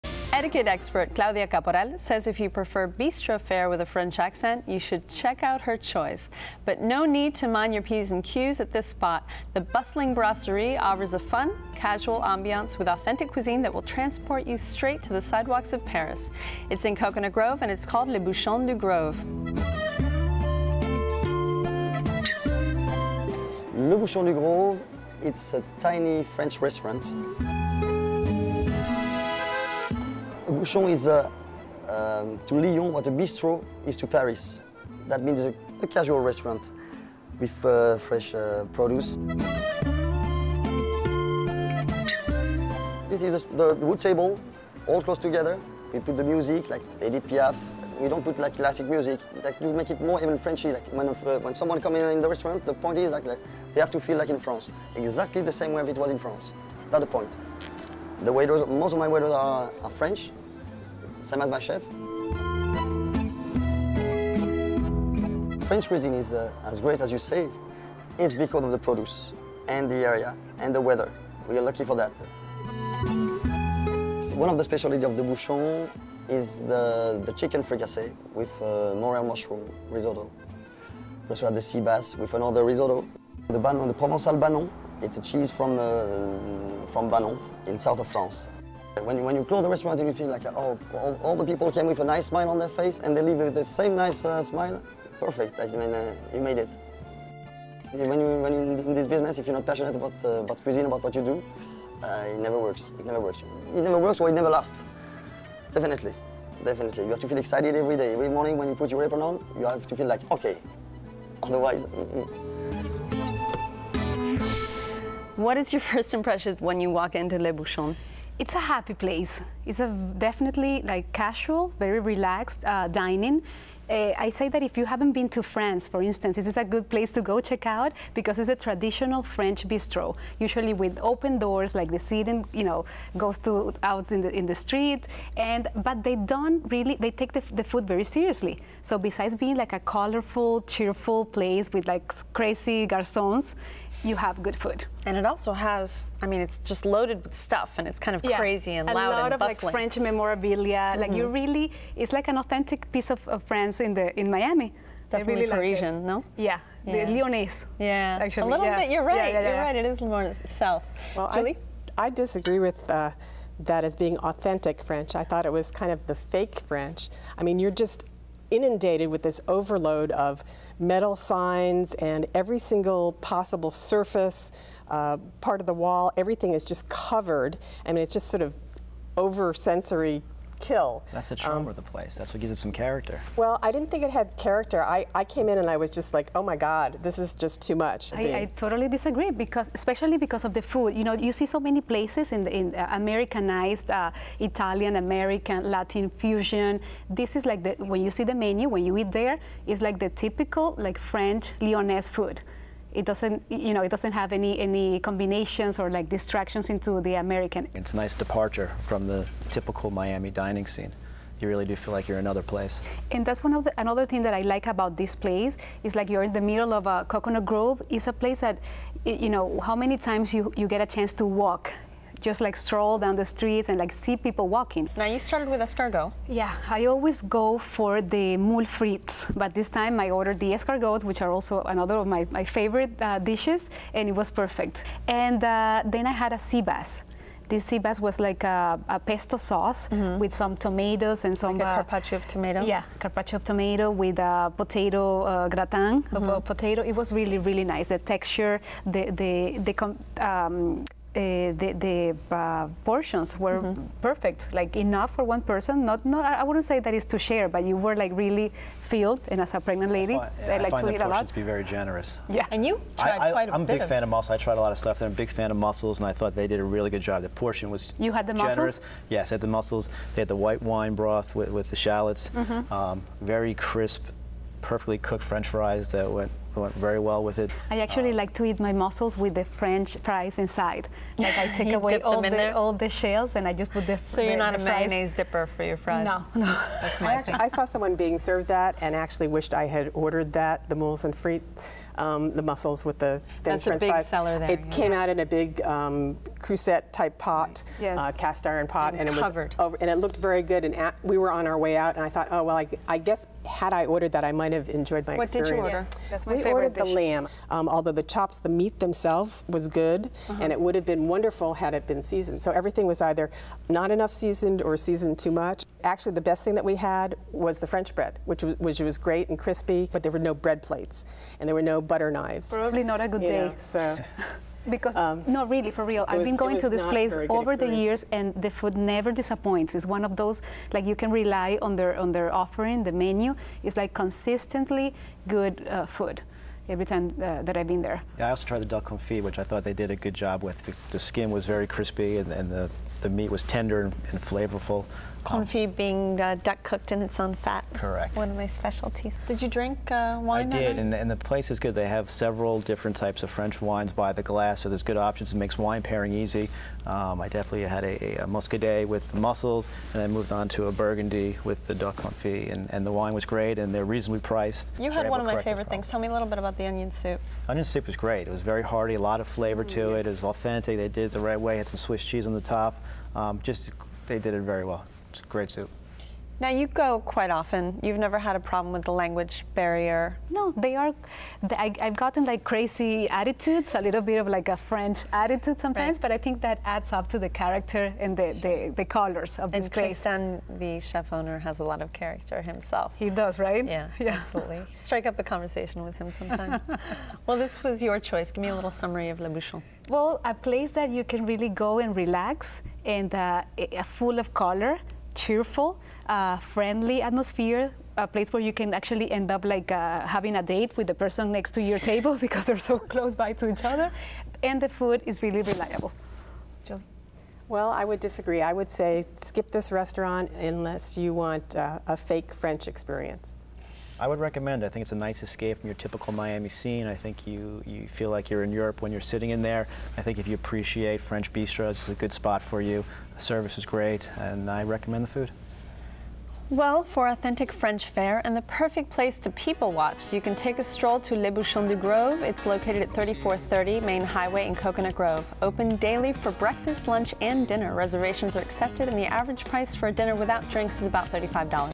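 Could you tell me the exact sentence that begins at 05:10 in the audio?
and it would have been wonderful had it been seasoned.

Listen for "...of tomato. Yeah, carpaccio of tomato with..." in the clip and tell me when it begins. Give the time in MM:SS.
04:02.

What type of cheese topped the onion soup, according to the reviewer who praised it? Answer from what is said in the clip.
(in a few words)
Swiss cheese.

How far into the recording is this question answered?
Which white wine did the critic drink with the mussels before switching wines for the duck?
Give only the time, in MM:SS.
05:58.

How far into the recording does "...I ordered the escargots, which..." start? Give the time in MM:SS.
03:49.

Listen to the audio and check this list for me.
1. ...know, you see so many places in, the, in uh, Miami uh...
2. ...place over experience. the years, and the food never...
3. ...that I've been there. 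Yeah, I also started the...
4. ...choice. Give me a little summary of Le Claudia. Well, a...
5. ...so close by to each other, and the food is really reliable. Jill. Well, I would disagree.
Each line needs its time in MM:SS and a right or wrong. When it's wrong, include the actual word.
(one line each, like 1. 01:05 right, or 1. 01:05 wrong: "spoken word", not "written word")
1. 03:11 wrong: "Americanized", not "Miami"
2. 05:26 right
3. 05:37 wrong: "tried", not "started"
4. 06:37 wrong: "Bouchon", not "Claudia"
5. 06:52 right.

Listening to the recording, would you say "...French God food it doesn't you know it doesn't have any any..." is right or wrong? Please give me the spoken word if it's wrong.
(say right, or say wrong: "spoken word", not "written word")
wrong: "Lyonnaise", not "God".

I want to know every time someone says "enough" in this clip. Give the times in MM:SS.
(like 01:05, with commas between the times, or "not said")
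04:14, 05:13.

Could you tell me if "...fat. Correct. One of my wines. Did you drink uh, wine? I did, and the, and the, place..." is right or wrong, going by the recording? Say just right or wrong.
wrong.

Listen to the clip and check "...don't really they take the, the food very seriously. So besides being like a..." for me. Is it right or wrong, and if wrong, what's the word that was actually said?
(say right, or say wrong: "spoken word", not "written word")
right.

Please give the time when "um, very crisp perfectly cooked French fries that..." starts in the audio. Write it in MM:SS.
04:32.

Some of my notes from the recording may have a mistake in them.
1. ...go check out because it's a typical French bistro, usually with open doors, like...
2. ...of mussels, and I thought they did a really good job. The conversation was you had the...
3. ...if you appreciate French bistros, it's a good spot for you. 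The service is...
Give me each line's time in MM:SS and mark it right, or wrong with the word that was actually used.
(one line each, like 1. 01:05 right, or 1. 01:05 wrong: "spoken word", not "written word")
1. 02:07 wrong: "traditional", not "typical"
2. 04:25 wrong: "portion", not "conversation"
3. 07:10 right.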